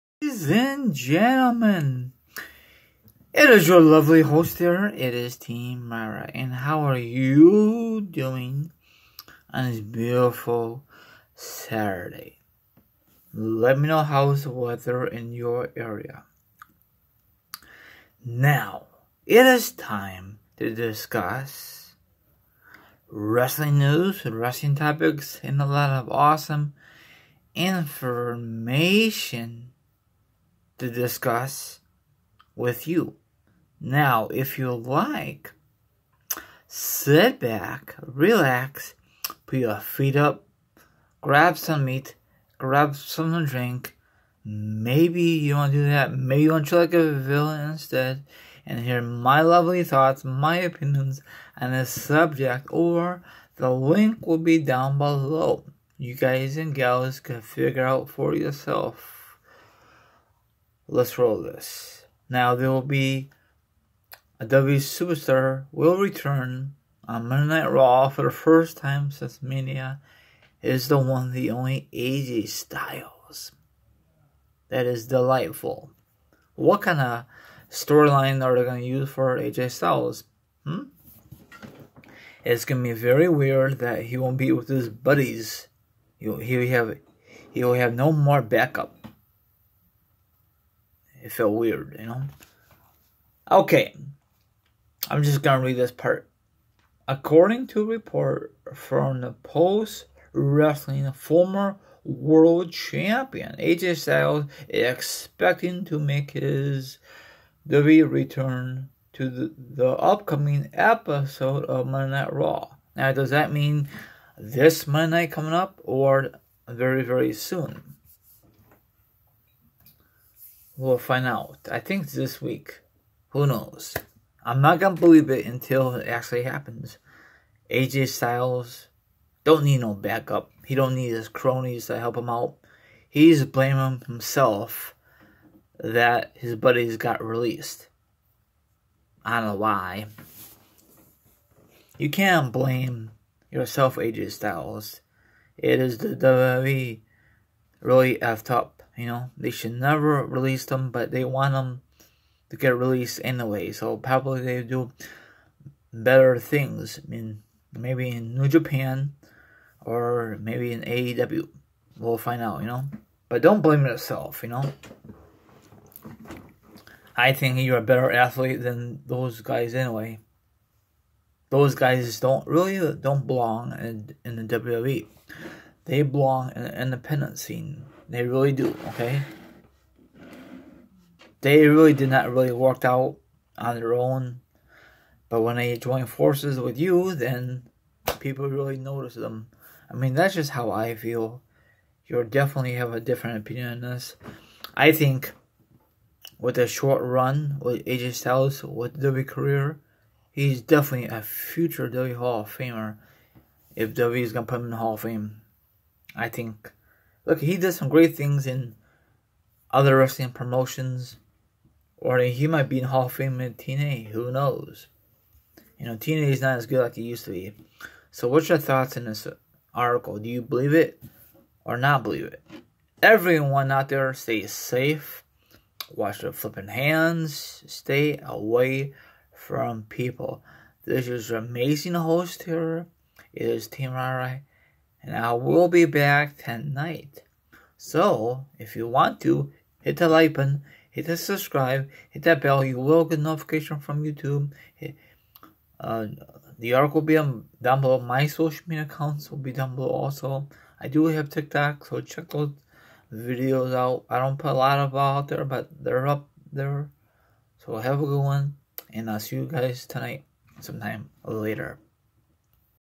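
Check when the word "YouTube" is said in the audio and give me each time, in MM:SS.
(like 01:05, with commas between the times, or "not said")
04:04.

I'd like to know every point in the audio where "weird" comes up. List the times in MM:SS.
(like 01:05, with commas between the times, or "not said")
01:23, 01:31.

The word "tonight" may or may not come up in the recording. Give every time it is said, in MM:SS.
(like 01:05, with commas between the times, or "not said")
03:56, 04:19.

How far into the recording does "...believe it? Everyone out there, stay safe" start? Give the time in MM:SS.
03:42.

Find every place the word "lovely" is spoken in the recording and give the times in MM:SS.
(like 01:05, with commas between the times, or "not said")
00:03, 00:49.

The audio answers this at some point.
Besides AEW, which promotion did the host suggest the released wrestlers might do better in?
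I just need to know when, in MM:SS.
02:38.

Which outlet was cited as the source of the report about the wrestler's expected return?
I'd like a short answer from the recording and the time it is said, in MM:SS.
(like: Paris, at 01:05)
Post Wrestling, at 01:39.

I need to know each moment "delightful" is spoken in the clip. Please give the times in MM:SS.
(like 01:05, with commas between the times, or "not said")
01:15.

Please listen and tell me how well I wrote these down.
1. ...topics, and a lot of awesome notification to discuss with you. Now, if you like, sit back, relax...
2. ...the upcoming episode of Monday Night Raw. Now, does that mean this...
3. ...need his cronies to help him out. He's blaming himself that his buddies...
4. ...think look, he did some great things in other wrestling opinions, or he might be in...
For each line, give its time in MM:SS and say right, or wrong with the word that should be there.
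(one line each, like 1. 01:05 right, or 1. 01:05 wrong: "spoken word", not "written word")
1. 00:24 wrong: "information", not "notification"
2. 01:49 right
3. 02:10 right
4. 03:26 wrong: "promotions", not "opinions".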